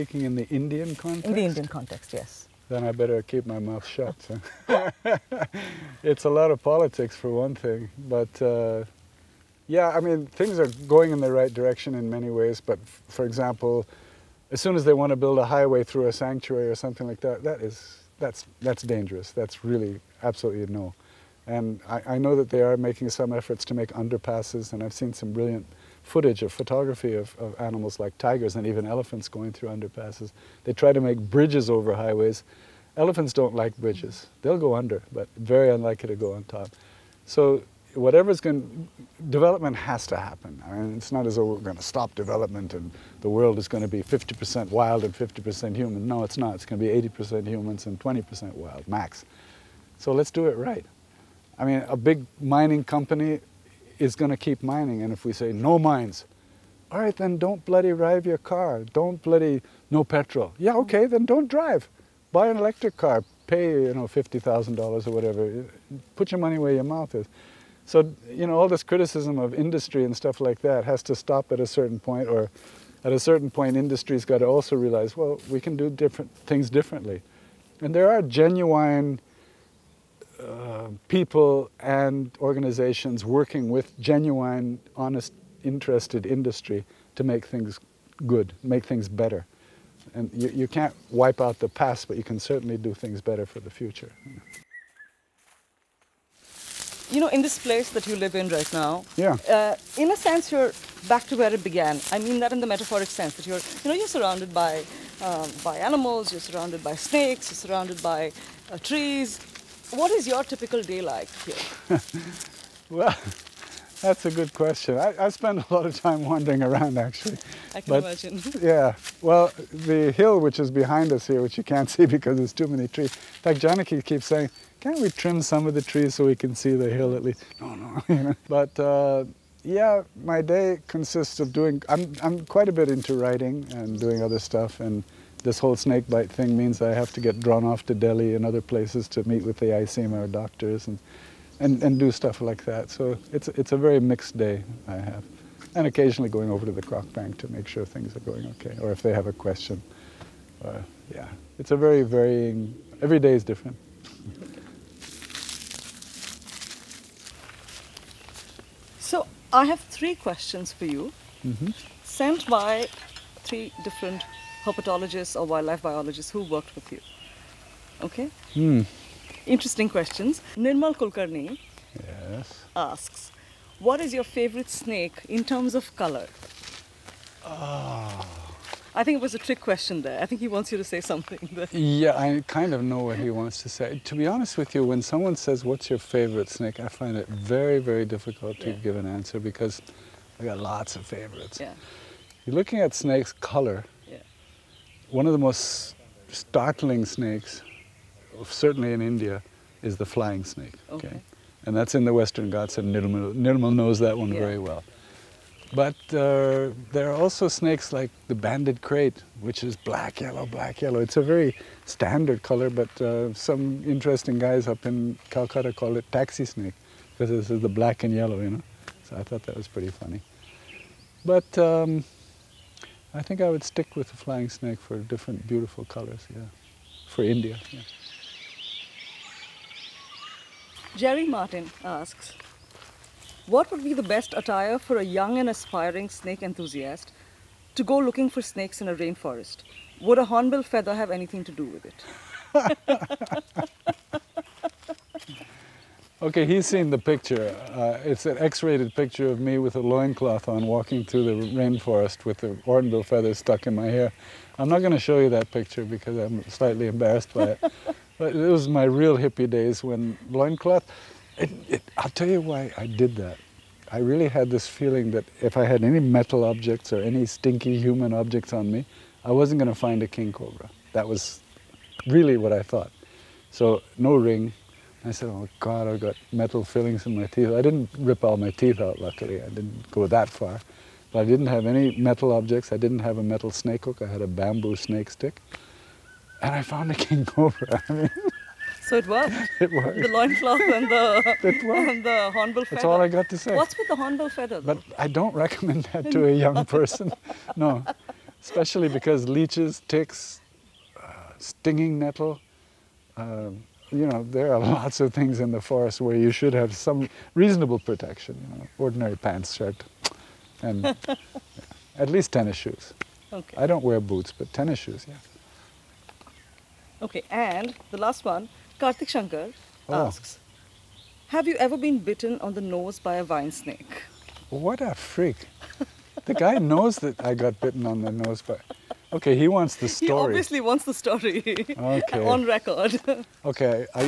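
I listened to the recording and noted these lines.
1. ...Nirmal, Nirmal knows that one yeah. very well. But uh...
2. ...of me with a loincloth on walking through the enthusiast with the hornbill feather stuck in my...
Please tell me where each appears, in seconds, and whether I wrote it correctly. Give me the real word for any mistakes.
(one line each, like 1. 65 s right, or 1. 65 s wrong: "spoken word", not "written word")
1. 202 s right
2. 249 s wrong: "rainforest", not "enthusiast".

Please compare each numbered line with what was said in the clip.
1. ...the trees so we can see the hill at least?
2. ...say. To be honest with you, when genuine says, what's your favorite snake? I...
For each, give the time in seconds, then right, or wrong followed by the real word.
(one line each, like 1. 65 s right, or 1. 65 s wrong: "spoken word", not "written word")
1. 125 s right
2. 183 s wrong: "someone", not "genuine".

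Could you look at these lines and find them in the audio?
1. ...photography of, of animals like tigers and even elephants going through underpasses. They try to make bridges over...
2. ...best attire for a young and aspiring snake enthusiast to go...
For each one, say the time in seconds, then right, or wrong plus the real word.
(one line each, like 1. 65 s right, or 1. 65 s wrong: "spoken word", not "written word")
1. 26 s right
2. 234 s right.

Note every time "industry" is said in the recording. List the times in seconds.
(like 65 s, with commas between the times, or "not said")
69 s, 73 s, 86 s.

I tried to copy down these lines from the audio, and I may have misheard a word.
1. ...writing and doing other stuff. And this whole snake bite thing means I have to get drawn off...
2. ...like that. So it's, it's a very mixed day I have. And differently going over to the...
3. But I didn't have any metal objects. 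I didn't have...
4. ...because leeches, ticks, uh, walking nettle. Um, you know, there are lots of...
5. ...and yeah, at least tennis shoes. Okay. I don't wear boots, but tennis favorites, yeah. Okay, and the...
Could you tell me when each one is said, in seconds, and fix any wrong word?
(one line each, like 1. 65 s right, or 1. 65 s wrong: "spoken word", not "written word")
1. 133 s right
2. 142 s wrong: "occasionally", not "differently"
3. 281 s right
4. 298 s wrong: "stinging", not "walking"
5. 310 s wrong: "shoes", not "favorites".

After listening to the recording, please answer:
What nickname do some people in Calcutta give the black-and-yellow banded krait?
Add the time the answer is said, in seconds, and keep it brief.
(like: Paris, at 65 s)
Taxi snake, at 216 s.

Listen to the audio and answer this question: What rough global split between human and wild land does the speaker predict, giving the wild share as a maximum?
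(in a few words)
80% humans, 20% wild.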